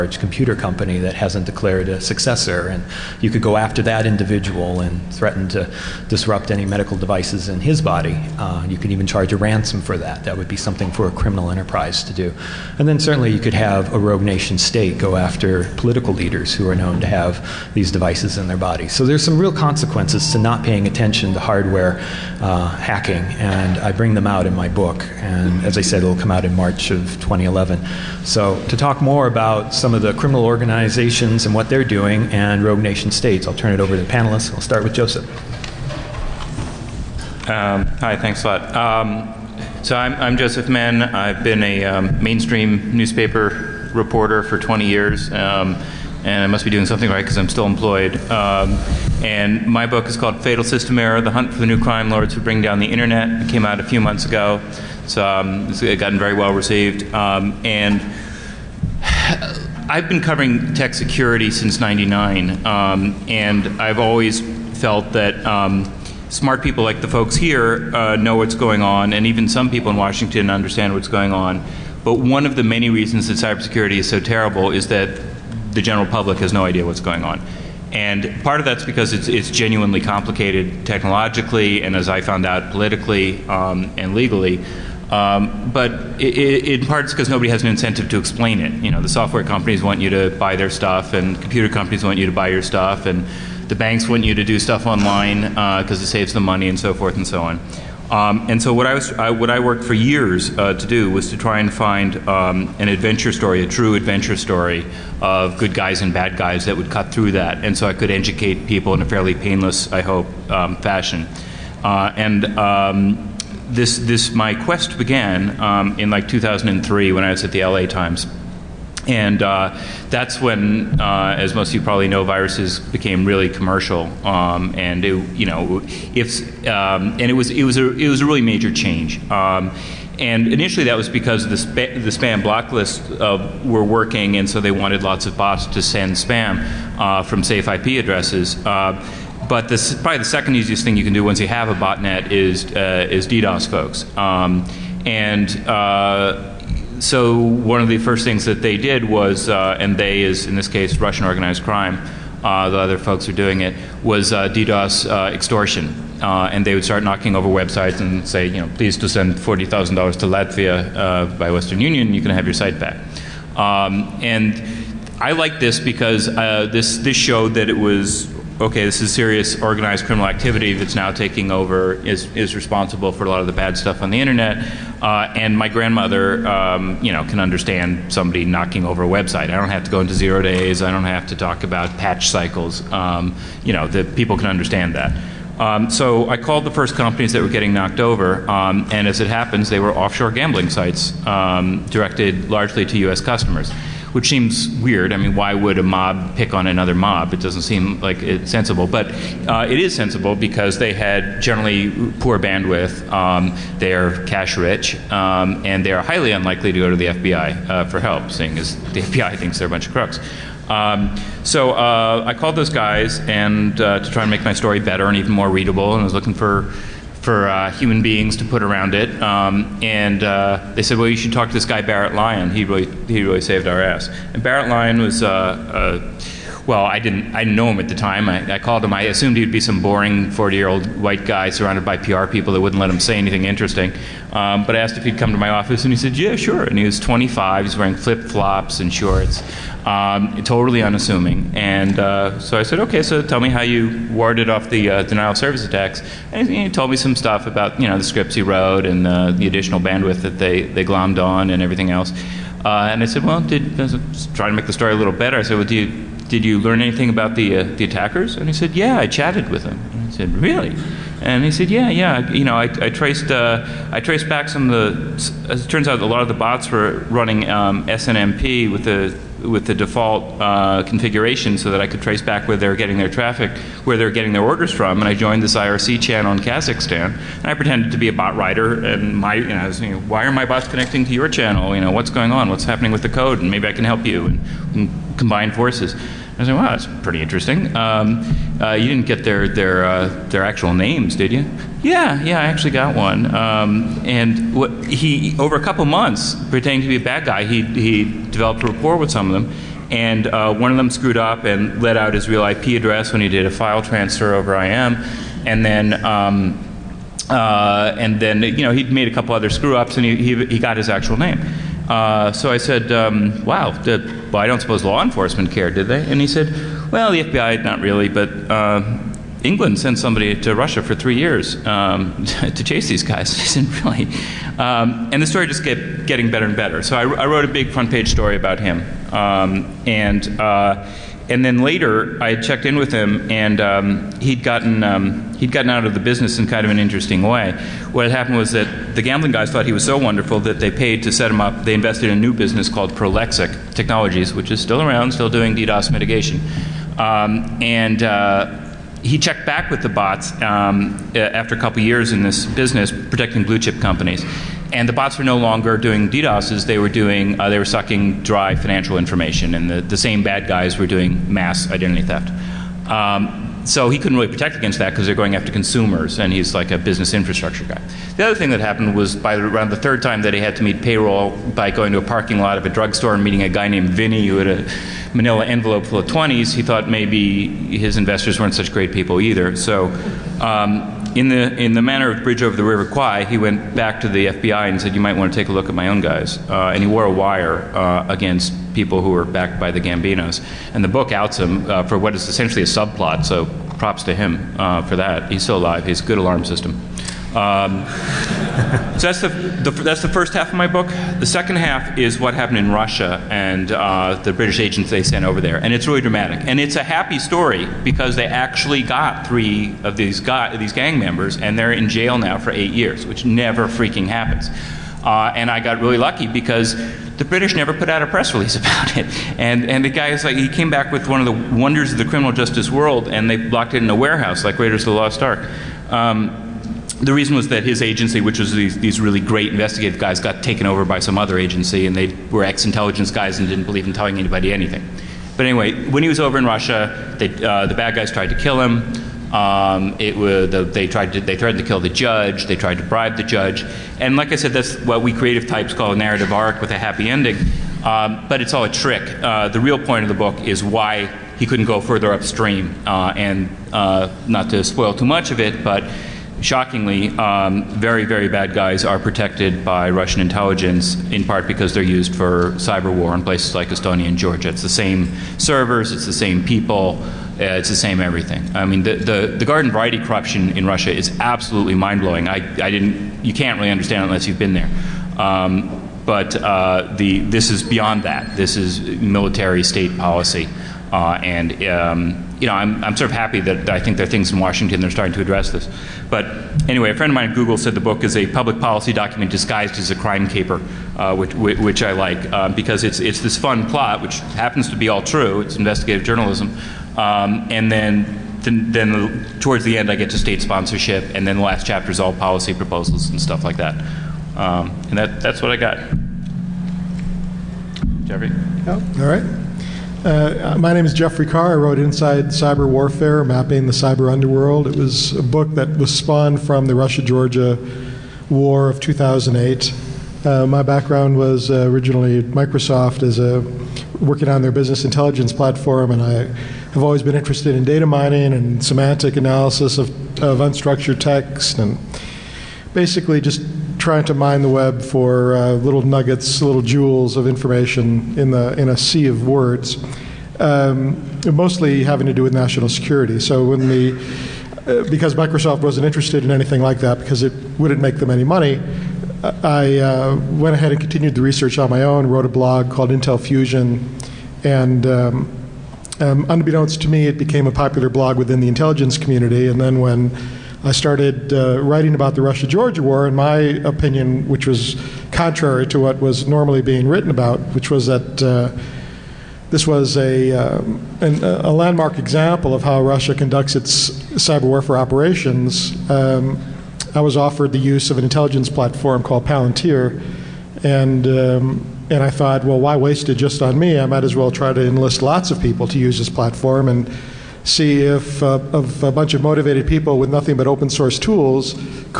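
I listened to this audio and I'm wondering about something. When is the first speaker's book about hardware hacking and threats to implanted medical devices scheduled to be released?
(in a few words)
March 2011.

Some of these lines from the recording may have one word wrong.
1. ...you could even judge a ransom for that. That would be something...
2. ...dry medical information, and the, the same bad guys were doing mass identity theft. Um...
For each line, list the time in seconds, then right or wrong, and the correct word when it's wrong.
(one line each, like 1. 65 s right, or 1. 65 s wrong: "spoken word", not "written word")
1. 8 s wrong: "charge", not "judge"
2. 358 s wrong: "financial", not "medical".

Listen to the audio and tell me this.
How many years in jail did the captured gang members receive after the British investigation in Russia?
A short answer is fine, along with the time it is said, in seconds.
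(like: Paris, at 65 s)
8, at 412 s.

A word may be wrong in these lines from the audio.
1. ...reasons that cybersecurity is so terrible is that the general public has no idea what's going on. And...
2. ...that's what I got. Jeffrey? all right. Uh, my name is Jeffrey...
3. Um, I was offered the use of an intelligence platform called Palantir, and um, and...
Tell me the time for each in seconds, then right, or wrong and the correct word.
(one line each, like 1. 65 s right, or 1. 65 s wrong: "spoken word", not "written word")
1. 72 s right
2. 505 s right
3. 575 s right.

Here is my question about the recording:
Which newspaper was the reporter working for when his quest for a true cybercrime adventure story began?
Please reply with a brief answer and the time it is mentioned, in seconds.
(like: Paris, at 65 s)
LA Times, at 117 s.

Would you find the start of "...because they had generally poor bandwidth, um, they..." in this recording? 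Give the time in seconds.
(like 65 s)
200 s.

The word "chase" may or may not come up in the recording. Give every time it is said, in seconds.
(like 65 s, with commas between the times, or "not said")
322 s.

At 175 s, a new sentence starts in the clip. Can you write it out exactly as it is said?
Uh, and my grandmother, um, you know, can understand somebody knocking over a website.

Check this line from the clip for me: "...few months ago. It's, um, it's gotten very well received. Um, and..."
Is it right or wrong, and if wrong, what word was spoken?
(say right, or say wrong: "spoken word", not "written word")
right.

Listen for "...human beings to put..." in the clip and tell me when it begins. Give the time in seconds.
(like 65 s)
217 s.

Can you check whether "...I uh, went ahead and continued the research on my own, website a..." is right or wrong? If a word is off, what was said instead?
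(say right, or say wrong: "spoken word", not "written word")
wrong: "wrote", not "website".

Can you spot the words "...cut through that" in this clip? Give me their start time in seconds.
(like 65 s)
106 s.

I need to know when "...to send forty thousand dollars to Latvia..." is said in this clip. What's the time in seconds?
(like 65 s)
158 s.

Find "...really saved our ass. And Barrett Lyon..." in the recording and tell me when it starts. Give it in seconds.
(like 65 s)
223 s.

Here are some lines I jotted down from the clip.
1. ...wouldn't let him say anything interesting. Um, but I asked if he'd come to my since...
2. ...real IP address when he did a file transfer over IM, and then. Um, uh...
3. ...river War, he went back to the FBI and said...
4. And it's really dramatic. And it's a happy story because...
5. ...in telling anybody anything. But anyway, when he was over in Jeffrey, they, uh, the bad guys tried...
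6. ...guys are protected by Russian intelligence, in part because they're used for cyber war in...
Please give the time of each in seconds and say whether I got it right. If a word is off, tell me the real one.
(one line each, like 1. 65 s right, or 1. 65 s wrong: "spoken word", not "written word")
1. 232 s wrong: "office", not "since"
2. 302 s right
3. 382 s wrong: "Kwai", not "War"
4. 405 s right
5. 433 s wrong: "Russia", not "Jeffrey"
6. 458 s right.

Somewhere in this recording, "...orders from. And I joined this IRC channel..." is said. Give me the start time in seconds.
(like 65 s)
274 s.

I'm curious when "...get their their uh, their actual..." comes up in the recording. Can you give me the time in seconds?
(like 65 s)
289 s.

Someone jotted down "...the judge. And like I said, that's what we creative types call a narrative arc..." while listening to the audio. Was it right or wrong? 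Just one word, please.
right.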